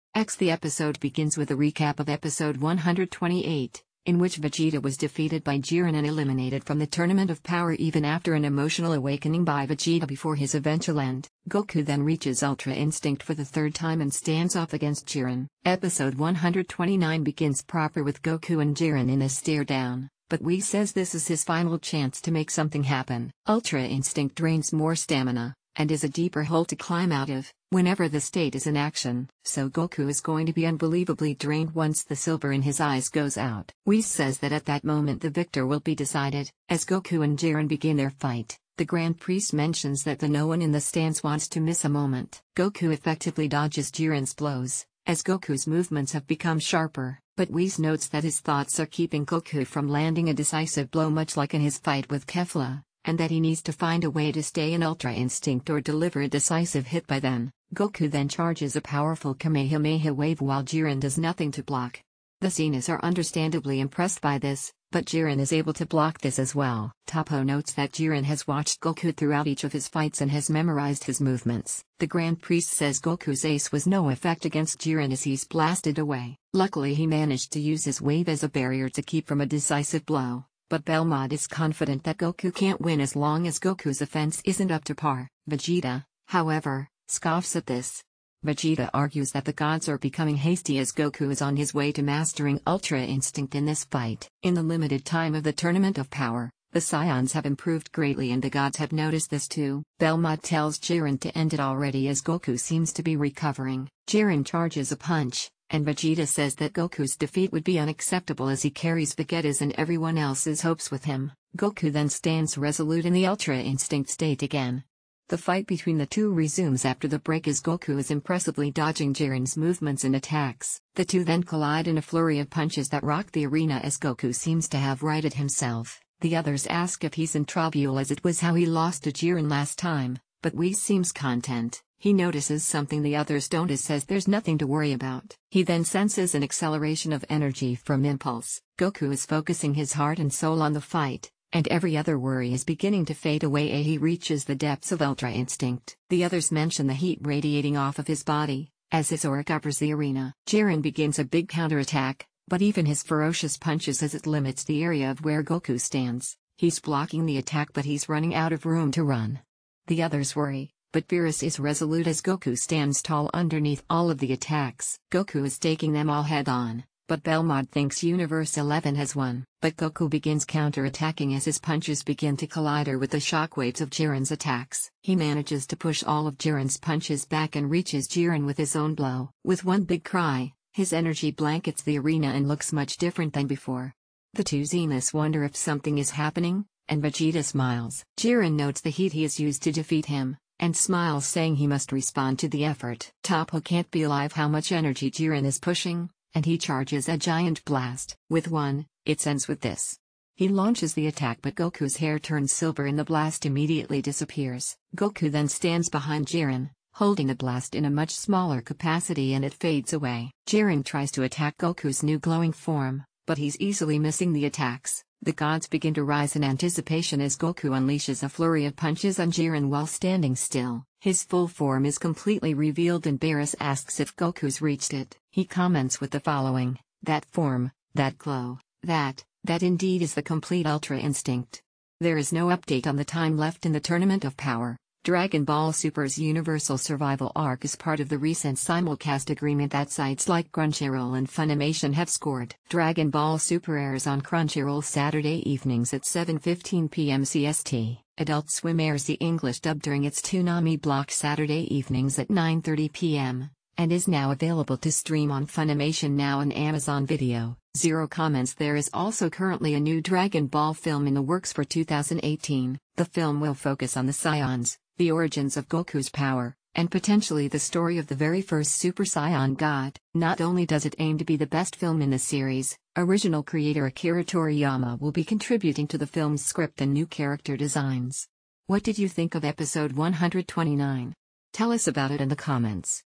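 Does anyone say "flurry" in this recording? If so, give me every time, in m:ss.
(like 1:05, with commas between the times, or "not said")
2:02, 3:38.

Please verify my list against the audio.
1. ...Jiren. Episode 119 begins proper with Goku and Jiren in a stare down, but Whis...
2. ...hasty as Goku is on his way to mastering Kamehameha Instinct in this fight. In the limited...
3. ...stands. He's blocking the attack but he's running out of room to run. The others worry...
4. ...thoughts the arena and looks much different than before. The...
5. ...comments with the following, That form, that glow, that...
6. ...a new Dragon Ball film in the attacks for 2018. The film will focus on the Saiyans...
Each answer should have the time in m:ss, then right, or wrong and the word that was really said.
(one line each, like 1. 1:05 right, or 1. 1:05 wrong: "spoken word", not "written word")
1. 0:15 wrong: "129", not "119"
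2. 1:30 wrong: "Ultra", not "Kamehameha"
3. 2:35 right
4. 3:01 wrong: "blankets", not "thoughts"
5. 3:45 right
6. 4:19 wrong: "works", not "attacks".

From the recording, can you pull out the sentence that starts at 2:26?
The others mention the heat radiating off of his body, as his aura covers the arena.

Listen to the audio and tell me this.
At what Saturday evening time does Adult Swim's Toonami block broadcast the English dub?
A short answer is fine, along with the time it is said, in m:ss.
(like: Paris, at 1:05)
9:30 p.m., at 4:12.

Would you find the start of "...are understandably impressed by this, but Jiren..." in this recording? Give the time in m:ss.
1:02.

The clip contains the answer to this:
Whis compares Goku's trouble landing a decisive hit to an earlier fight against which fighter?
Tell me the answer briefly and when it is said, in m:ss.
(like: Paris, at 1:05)
Kefla, at 0:52.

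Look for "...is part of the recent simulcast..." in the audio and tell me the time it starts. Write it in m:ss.
3:57.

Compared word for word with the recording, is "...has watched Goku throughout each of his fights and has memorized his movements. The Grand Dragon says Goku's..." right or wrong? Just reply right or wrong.
wrong.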